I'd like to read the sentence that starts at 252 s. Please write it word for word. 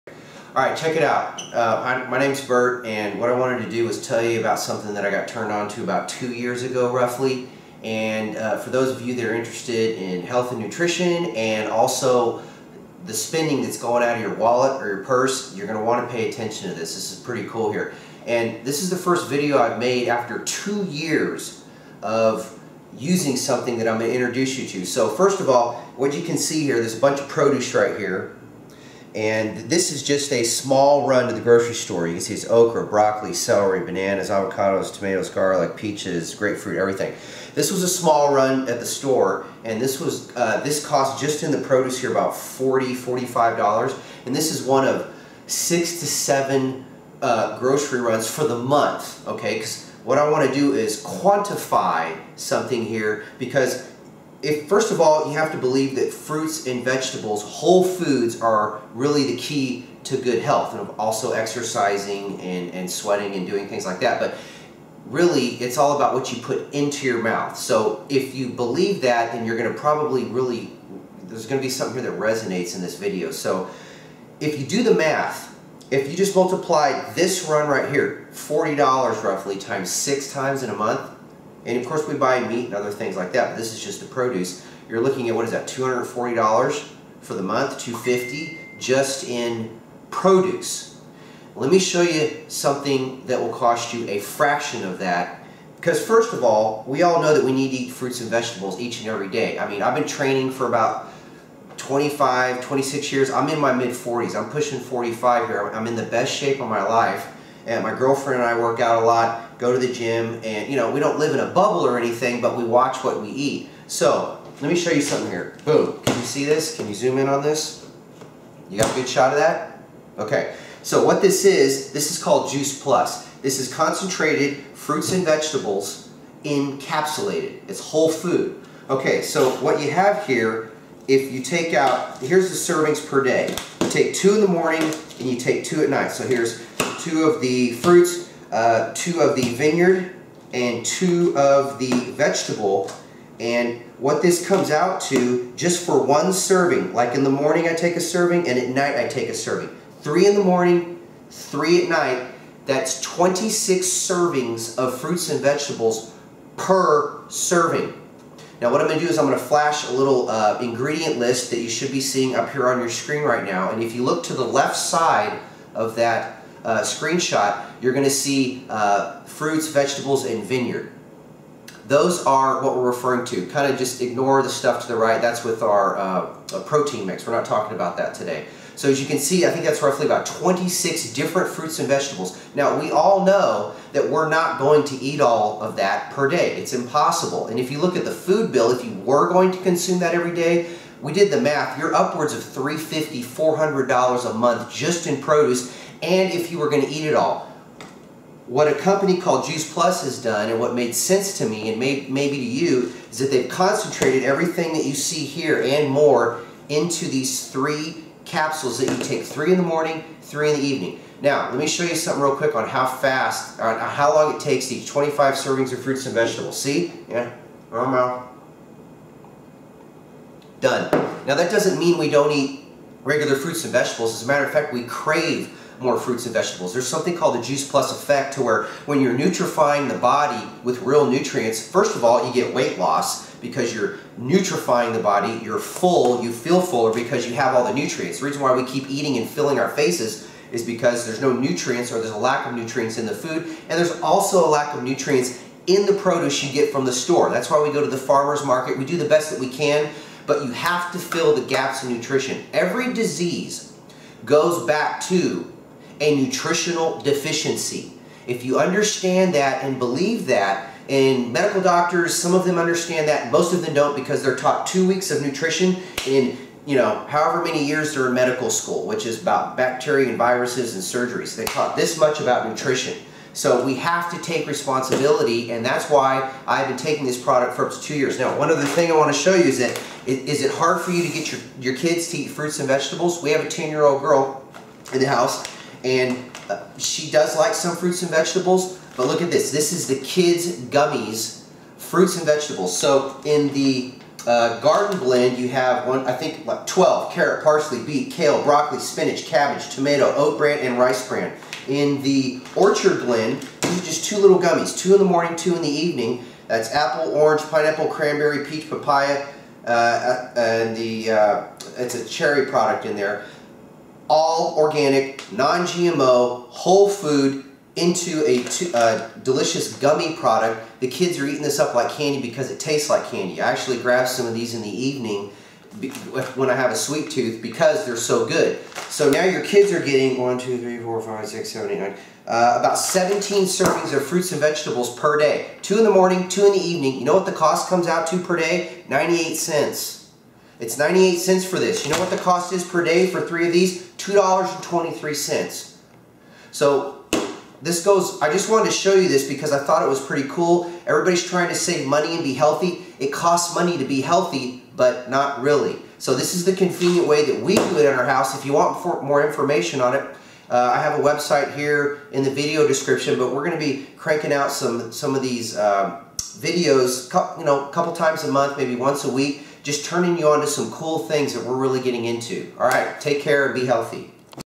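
Every disease goes back to a nutritional deficiency.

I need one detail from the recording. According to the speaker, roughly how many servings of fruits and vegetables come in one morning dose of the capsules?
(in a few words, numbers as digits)
26.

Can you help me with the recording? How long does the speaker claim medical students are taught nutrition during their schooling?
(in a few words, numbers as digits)
two weeks.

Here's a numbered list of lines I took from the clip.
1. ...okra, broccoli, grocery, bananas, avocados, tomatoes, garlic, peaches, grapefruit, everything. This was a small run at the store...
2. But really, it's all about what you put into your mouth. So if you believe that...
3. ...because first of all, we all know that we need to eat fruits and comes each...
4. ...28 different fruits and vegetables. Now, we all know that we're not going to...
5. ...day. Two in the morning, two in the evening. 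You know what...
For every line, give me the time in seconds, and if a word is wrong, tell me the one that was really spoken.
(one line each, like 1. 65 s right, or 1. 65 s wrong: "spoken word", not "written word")
1. 32 s wrong: "celery", not "grocery"
2. 64 s right
3. 95 s wrong: "vegetables", not "comes"
4. 180 s wrong: "26", not "28"
5. 335 s right.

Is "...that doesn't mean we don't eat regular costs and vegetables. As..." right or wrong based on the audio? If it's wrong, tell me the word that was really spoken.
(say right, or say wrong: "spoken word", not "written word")
wrong: "fruits", not "costs".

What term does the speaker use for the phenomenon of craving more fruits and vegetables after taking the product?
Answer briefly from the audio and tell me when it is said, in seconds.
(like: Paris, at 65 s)
the juice plus effect, at 227 s.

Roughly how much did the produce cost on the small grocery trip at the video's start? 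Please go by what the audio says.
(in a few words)
$40.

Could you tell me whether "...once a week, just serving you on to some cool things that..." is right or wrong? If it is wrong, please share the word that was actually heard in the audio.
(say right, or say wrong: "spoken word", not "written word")
wrong: "turning", not "serving".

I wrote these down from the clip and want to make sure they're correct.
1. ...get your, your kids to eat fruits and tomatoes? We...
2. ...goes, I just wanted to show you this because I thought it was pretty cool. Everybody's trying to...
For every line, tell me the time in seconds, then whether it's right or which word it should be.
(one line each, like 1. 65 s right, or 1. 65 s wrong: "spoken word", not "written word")
1. 281 s wrong: "vegetables", not "tomatoes"
2. 347 s right.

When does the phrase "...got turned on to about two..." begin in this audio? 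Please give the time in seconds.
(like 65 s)
5 s.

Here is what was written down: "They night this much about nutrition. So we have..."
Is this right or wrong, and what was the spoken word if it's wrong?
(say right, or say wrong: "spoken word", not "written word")
wrong: "taught", not "night".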